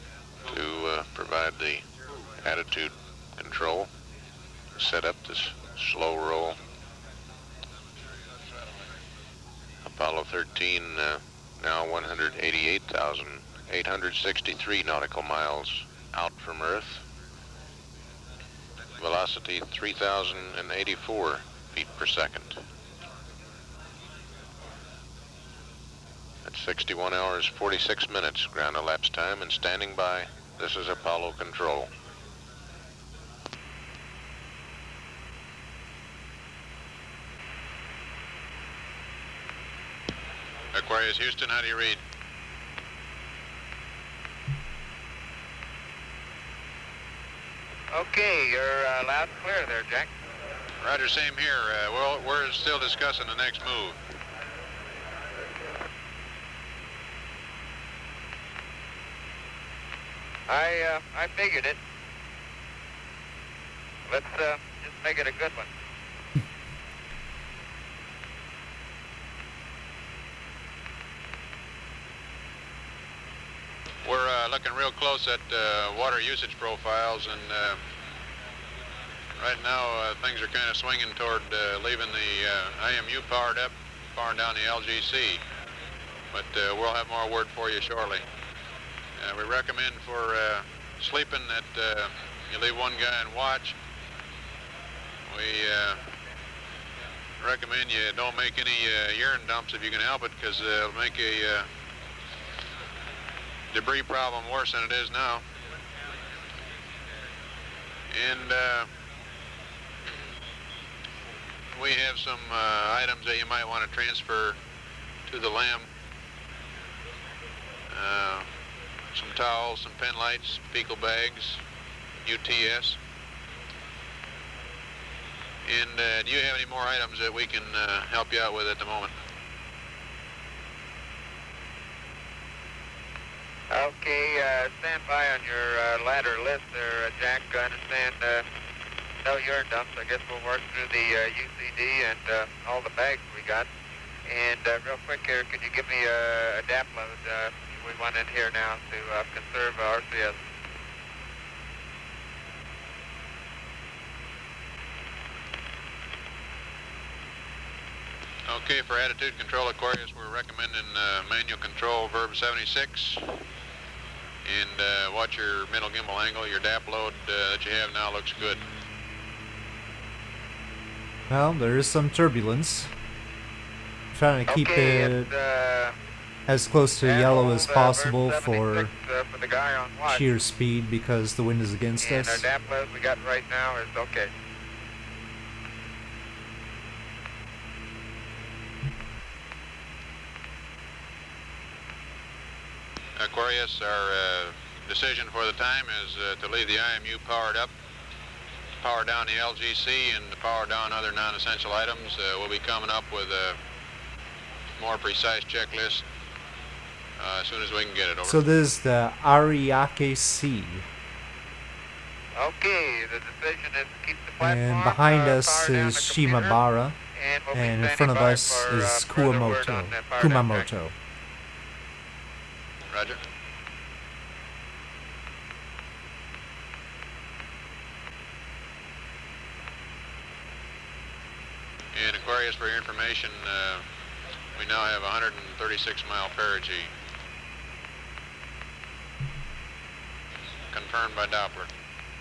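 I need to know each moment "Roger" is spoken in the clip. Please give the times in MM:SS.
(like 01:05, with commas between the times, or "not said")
00:50, 03:42.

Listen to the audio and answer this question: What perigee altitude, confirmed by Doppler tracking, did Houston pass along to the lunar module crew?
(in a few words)
136 miles.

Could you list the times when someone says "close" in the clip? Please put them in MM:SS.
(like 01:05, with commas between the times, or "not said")
01:14, 02:56.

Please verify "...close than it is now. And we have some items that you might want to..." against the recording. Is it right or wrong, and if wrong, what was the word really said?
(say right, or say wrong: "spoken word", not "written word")
wrong: "worse", not "close".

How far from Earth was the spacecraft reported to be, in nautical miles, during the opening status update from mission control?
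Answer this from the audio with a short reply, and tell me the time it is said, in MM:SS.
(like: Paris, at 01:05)
188,863, at 00:11.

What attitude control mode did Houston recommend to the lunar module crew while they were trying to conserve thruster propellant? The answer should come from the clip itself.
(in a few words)
manual control verb 76.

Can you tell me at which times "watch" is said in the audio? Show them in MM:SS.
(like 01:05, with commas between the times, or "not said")
01:33, 02:45.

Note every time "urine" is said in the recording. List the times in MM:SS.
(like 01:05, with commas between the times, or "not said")
01:39, 02:19.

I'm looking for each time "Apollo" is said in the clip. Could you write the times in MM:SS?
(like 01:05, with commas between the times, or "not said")
00:09, 00:30.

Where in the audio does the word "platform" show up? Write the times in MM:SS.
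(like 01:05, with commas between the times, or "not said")
03:34.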